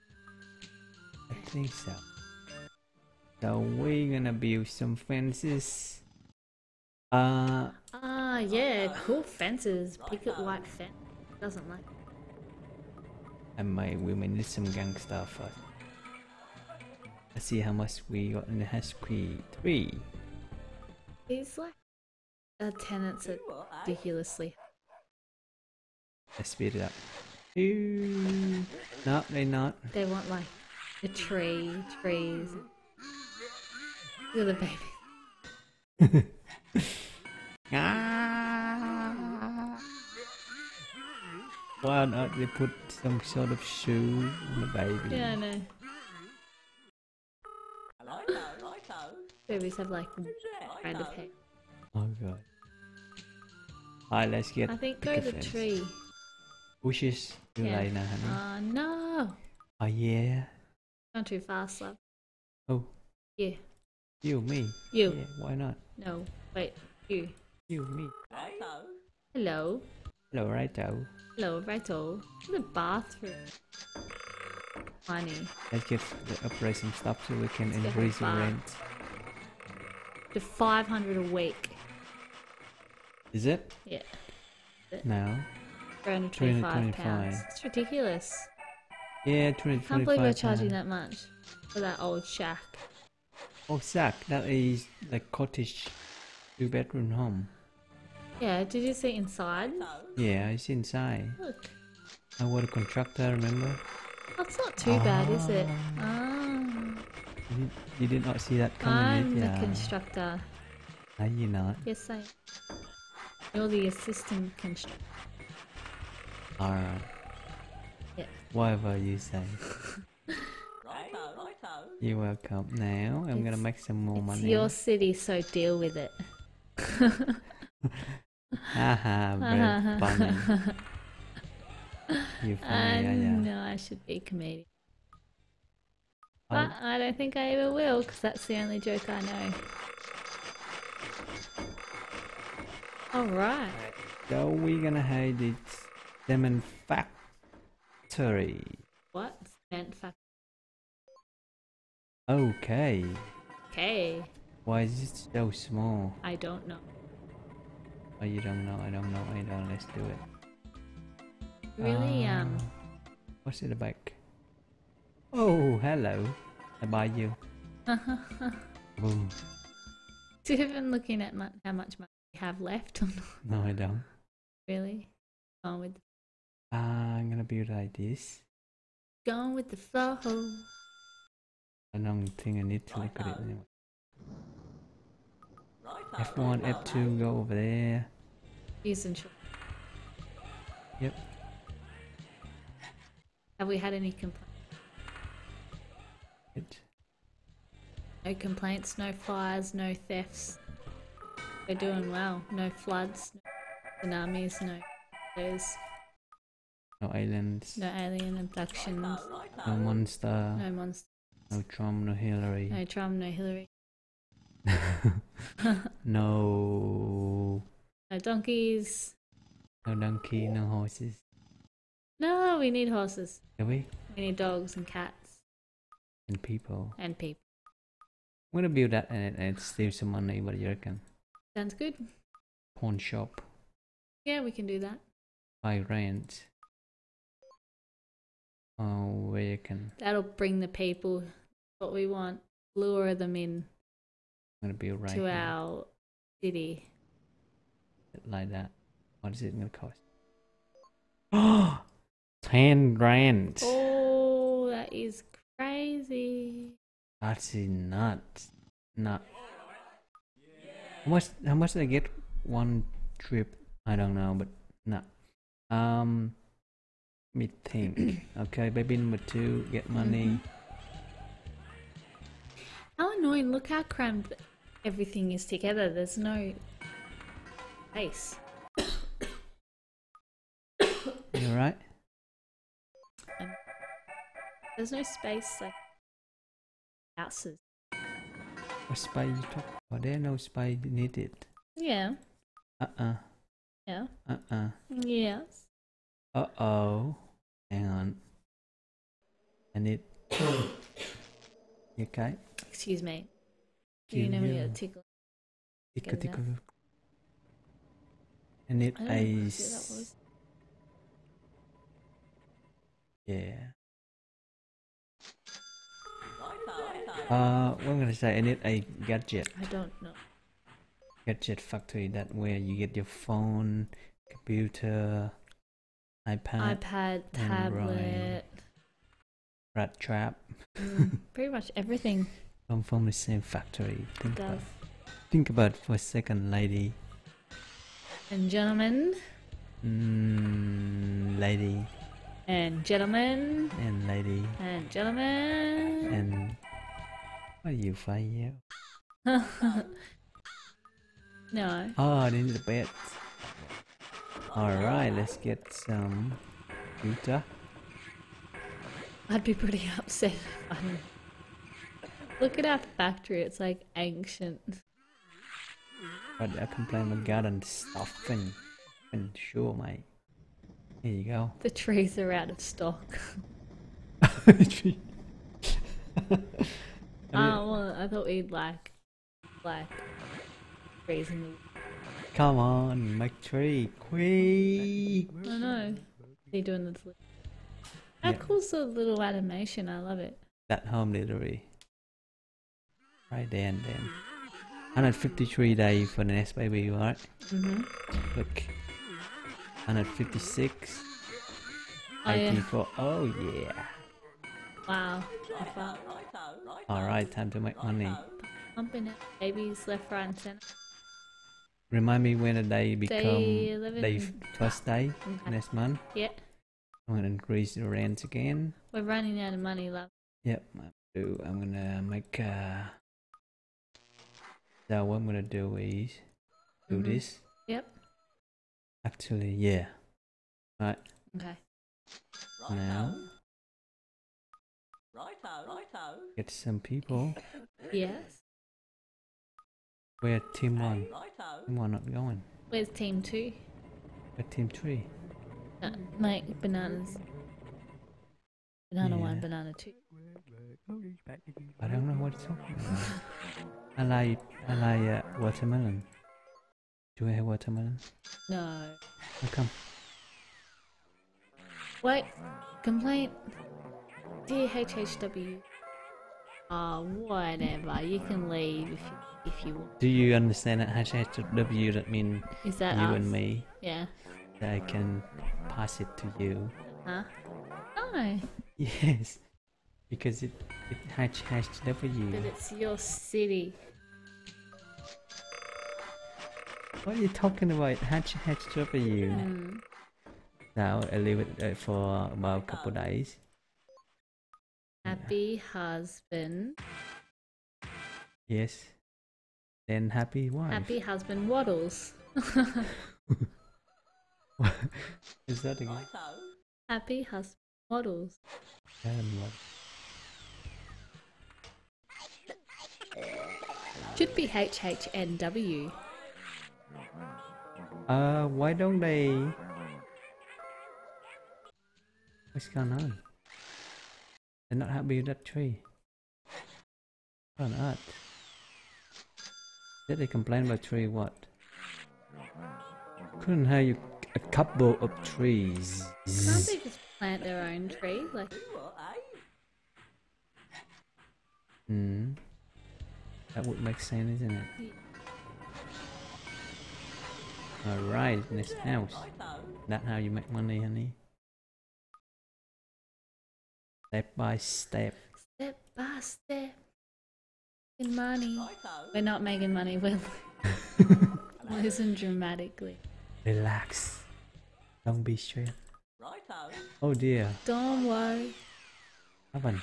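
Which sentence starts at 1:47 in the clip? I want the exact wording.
You did, you did not see that coming, I'm the constructor.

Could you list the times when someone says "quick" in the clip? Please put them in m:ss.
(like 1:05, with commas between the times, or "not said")
6:23.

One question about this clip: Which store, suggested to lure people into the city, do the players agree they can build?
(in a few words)
Pawn shop.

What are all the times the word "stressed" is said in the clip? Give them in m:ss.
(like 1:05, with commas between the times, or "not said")
9:25.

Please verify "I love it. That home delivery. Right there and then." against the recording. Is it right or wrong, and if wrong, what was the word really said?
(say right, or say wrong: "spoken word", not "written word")
right.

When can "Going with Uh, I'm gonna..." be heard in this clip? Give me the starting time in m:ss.
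2:55.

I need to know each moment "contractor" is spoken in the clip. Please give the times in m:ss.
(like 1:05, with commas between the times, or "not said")
1:42.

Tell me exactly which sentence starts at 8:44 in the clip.
They're not happy with that tree.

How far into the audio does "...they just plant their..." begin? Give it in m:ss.
8:56.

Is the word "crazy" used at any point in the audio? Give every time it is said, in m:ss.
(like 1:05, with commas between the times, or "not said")
4:15.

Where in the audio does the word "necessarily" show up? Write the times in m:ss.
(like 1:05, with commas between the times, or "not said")
not said.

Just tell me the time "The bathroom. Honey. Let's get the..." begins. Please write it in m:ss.
1:12.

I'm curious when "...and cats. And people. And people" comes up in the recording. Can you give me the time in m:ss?
3:44.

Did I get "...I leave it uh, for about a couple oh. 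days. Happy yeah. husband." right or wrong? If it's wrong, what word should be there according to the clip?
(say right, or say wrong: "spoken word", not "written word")
right.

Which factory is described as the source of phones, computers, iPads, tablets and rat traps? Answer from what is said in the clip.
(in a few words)
Gadget factory.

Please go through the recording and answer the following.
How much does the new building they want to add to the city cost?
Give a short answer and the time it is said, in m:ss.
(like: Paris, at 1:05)
ten grand, at 4:12.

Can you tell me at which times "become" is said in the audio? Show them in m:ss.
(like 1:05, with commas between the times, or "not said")
6:52.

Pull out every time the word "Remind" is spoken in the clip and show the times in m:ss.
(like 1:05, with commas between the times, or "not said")
6:51.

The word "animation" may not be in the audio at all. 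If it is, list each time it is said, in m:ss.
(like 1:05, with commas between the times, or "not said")
6:29.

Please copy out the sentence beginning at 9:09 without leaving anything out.
That how you make money, honey?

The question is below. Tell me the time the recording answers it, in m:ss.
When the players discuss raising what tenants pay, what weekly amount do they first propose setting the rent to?
1:20.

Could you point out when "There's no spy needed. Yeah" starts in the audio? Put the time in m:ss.
4:50.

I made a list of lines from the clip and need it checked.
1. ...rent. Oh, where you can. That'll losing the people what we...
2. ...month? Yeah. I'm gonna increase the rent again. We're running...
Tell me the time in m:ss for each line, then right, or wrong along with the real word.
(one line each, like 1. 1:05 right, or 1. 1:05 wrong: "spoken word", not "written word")
1. 3:55 wrong: "bring", not "losing"
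2. 6:55 right.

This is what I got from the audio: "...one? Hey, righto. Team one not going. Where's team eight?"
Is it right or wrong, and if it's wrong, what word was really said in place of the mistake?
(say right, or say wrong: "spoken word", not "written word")
wrong: "two", not "eight".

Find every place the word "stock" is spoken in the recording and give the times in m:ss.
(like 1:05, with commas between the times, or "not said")
6:12.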